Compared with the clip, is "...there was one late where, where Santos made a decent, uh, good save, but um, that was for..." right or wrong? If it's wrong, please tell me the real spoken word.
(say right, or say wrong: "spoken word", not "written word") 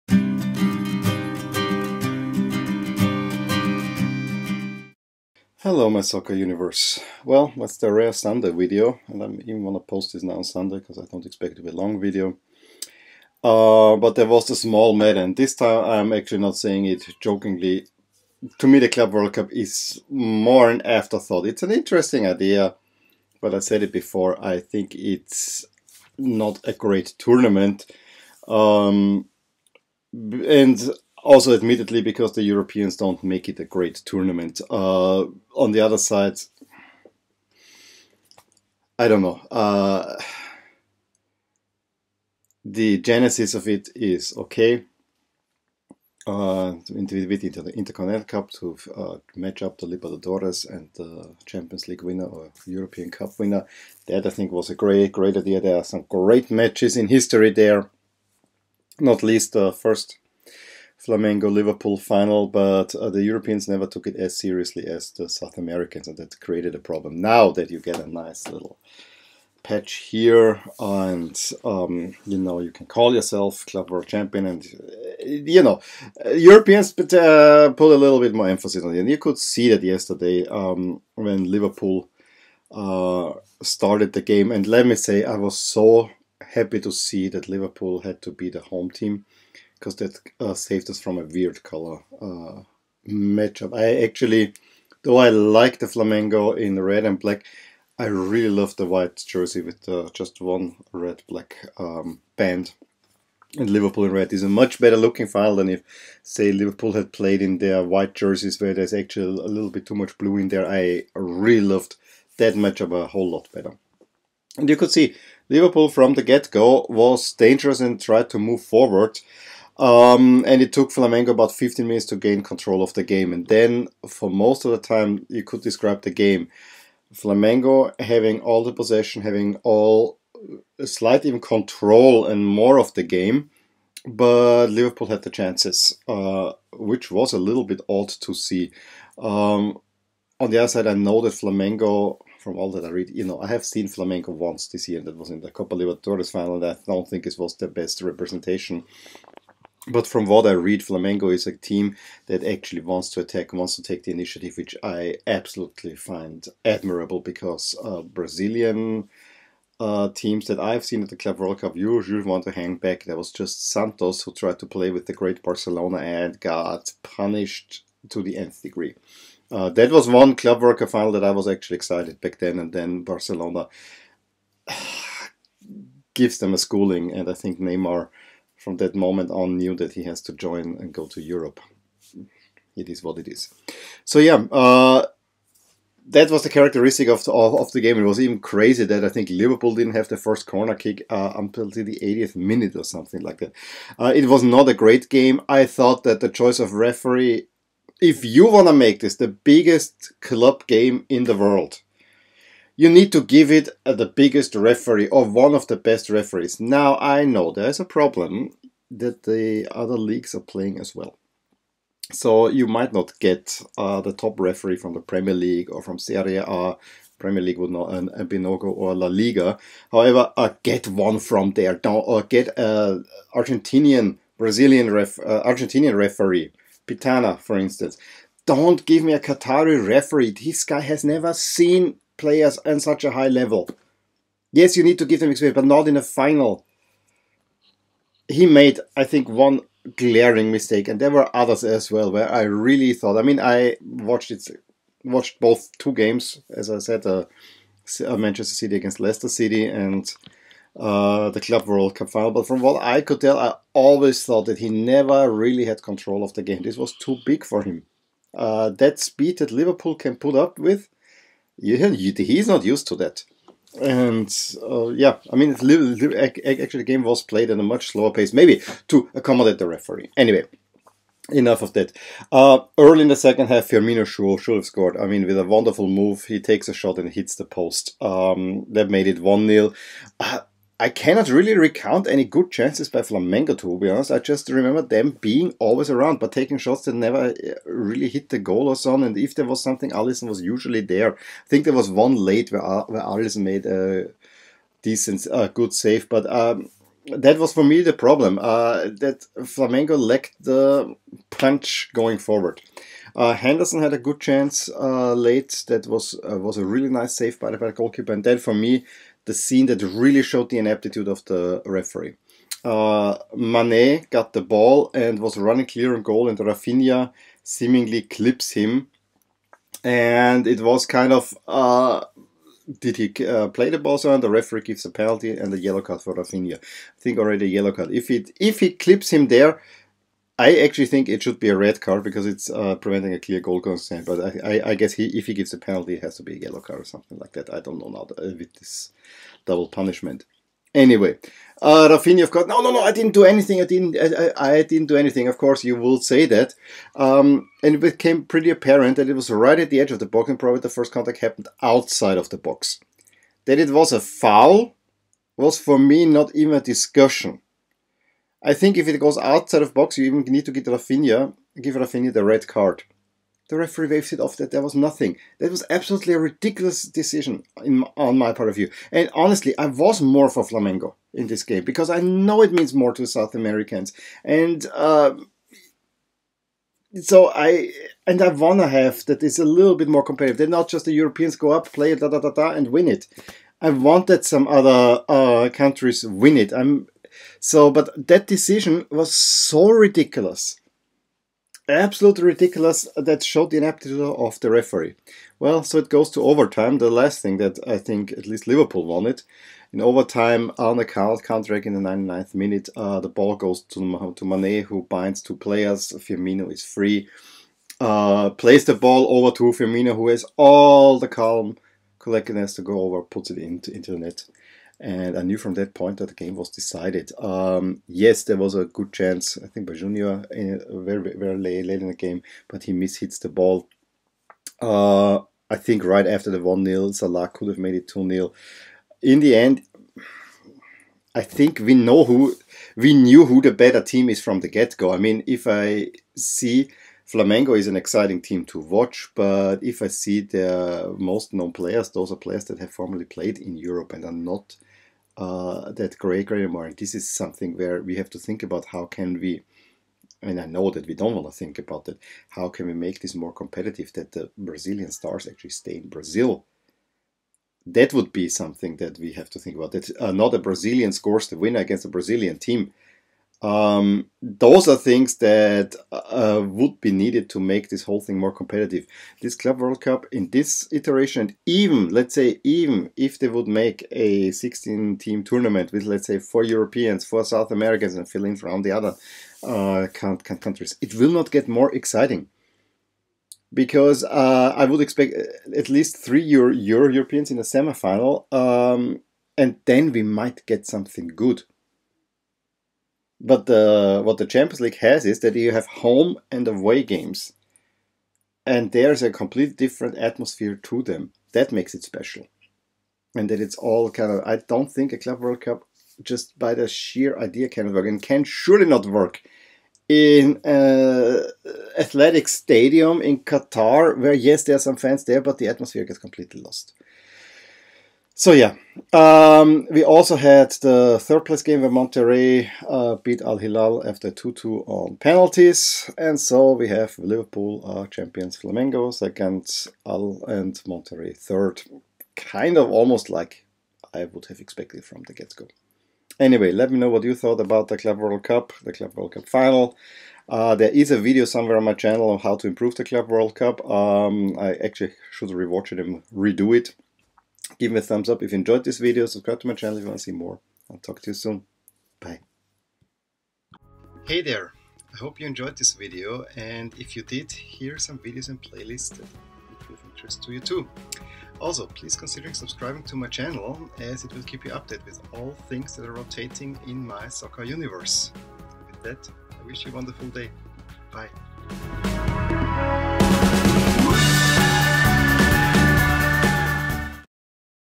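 wrong: "Alisson", not "Santos".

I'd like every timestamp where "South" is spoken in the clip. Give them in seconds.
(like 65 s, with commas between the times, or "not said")
65 s, 373 s, 477 s.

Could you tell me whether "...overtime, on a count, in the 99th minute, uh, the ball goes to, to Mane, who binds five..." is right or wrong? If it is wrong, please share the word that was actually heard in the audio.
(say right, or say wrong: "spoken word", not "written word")
wrong: "two", not "five".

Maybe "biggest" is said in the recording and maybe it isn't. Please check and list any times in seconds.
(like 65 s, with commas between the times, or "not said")
199 s, 204 s.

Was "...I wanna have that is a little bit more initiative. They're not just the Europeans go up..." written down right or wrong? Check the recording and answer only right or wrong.
wrong.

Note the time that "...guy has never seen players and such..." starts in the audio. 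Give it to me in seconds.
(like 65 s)
230 s.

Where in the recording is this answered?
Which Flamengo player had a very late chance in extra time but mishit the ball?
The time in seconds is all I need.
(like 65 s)
419 s.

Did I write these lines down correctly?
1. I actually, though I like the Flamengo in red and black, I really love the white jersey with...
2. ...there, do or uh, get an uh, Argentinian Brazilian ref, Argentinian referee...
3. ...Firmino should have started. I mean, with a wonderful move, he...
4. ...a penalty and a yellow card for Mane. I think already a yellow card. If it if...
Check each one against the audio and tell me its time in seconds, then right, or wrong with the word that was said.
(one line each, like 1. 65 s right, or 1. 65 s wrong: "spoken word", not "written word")
1. 93 s right
2. 221 s right
3. 273 s wrong: "scored", not "started"
4. 324 s wrong: "Rafinha", not "Mane".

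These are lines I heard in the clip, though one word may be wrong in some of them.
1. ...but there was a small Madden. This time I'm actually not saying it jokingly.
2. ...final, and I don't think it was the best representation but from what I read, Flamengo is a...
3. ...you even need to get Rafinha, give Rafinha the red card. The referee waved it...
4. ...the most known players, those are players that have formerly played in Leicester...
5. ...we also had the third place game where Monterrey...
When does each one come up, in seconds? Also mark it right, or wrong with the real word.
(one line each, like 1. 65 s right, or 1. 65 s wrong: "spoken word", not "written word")
1. 13 s right
2. 146 s right
3. 359 s right
4. 440 s wrong: "Europe", not "Leicester"
5. 519 s right.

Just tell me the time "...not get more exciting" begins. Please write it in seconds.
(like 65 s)
481 s.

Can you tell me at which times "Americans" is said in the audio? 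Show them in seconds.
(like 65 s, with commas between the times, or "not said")
65 s, 373 s, 477 s.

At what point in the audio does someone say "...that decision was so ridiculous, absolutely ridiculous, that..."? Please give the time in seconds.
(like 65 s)
388 s.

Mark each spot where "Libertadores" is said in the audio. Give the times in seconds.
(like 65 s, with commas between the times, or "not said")
49 s, 145 s.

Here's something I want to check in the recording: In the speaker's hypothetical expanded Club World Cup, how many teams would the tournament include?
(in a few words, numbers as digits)
16.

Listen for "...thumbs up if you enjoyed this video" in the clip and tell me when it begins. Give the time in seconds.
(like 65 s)
547 s.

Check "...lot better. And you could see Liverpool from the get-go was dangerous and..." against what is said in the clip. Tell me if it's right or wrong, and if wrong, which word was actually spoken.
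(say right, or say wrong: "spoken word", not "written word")
right.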